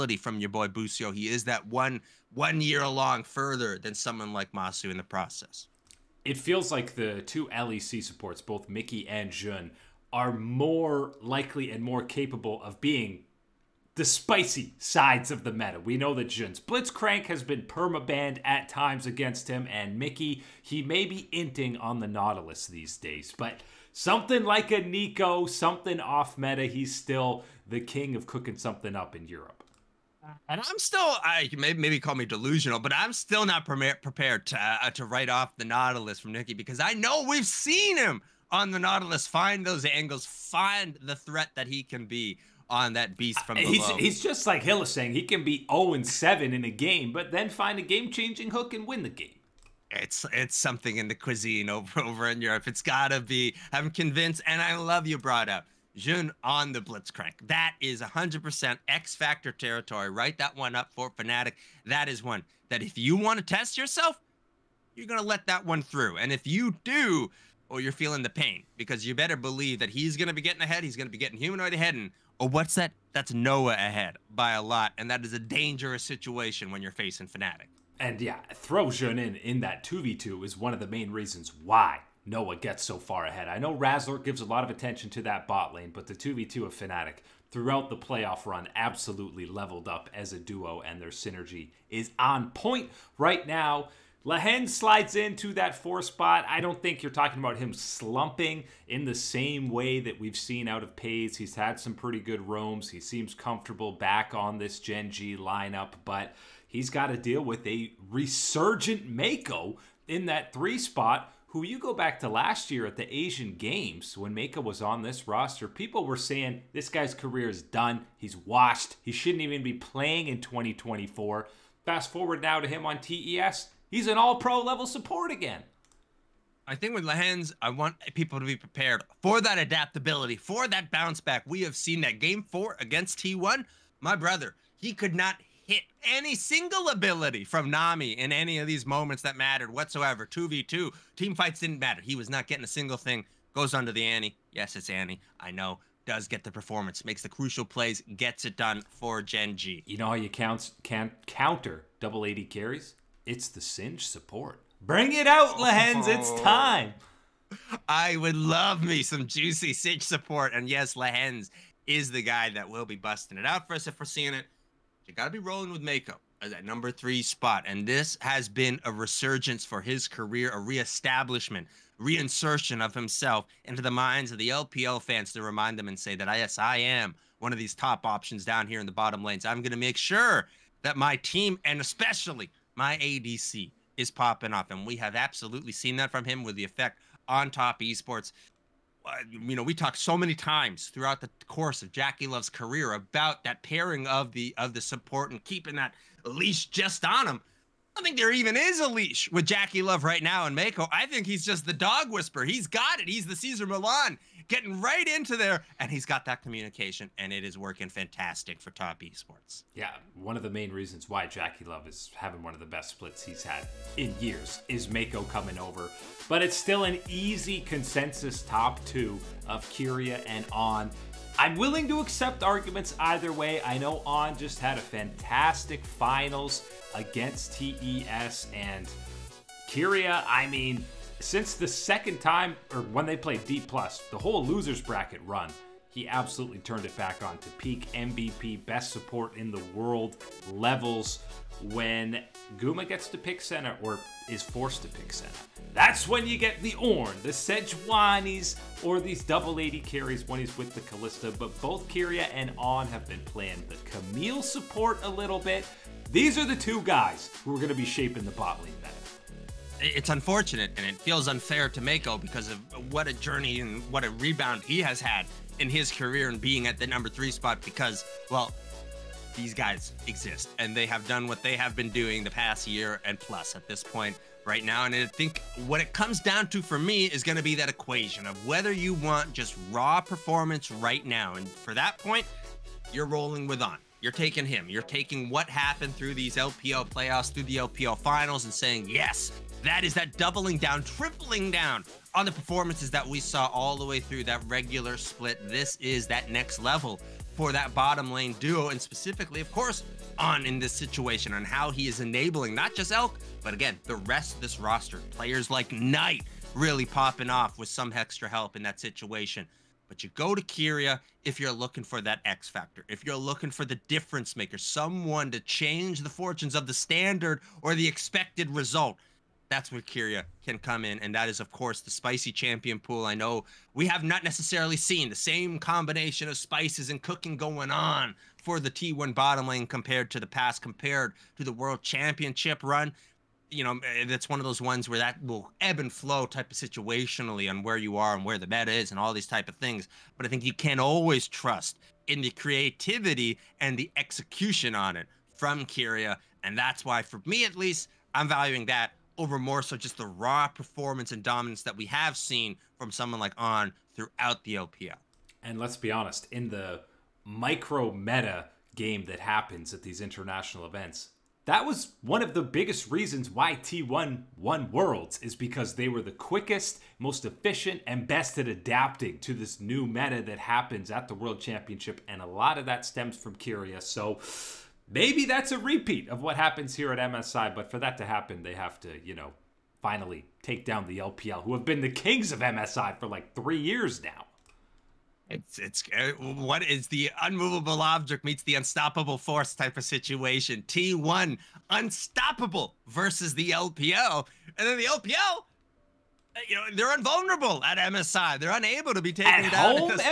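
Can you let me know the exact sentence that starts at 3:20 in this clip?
I think he's just the dog whisperer.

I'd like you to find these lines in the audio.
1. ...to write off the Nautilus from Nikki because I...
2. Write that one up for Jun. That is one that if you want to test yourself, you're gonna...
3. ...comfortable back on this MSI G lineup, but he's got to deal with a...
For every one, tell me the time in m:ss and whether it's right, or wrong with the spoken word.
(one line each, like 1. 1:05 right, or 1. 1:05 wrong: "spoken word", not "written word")
1. 0:34 right
2. 1:00 wrong: "Fnatic", not "Jun"
3. 1:43 wrong: "Gen", not "MSI".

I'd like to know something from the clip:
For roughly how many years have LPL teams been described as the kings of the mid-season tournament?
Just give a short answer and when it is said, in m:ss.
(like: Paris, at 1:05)
3, at 6:23.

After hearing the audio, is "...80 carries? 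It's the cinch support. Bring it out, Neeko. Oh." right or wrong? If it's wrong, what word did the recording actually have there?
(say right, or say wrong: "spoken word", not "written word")
wrong: "Lehends", not "Neeko".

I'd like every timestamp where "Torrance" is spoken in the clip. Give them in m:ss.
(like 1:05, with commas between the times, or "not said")
not said.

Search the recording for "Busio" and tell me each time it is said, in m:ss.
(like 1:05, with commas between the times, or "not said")
0:00.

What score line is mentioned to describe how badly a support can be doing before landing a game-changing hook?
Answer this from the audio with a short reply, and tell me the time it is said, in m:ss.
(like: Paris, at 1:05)
0 and 7, at 0:45.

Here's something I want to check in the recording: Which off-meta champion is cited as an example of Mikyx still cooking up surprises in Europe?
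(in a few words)
Neeko.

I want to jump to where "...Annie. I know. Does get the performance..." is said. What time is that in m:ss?
2:24.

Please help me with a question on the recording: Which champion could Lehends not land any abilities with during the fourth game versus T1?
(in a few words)
Nami.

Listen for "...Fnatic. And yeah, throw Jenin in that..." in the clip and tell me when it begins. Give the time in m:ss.
1:17.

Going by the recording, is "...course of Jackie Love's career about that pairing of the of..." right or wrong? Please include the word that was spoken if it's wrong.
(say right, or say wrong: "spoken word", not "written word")
right.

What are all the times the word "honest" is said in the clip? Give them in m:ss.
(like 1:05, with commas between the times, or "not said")
5:55.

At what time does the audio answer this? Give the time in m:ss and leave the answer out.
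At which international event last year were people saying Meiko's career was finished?
1:53.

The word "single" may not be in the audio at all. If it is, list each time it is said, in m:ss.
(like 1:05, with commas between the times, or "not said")
2:16, 2:22.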